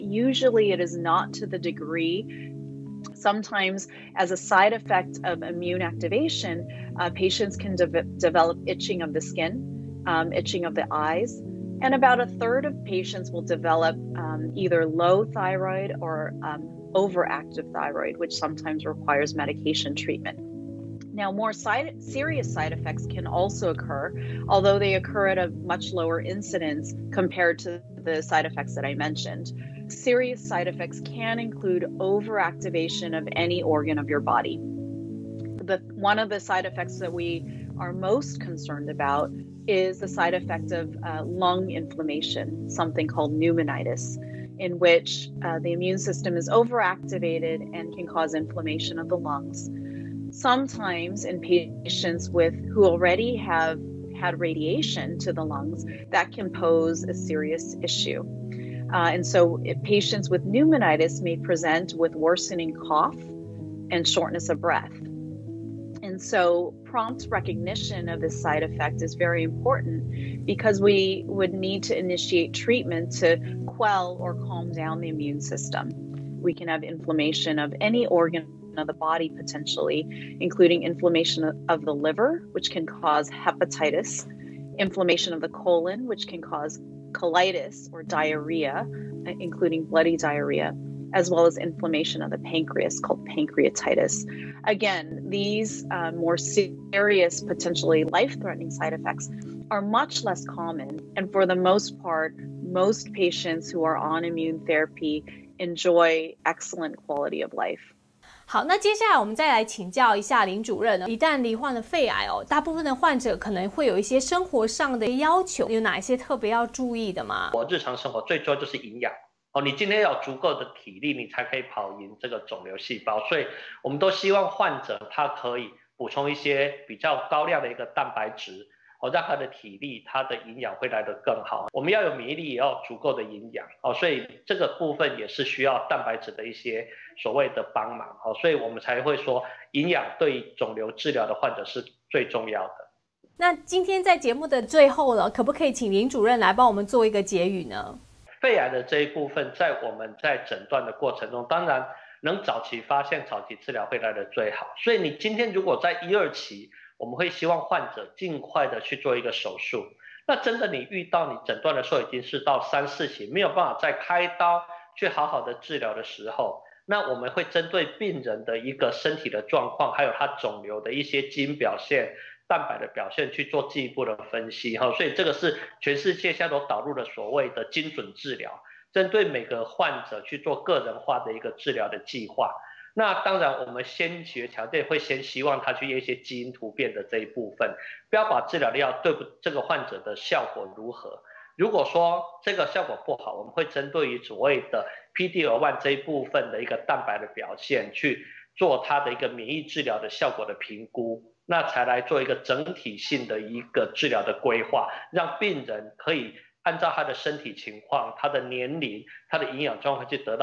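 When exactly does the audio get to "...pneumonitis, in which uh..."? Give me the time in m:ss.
0:43.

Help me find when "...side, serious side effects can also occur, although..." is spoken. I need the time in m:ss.
0:21.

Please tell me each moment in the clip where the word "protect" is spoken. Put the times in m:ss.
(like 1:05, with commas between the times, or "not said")
not said.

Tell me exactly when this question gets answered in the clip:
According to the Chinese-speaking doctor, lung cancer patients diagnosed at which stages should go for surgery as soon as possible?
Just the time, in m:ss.
2:36.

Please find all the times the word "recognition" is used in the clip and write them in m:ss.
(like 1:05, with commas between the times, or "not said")
1:07.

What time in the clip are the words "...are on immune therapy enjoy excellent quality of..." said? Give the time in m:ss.
1:43.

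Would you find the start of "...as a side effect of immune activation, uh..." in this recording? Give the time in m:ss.
0:04.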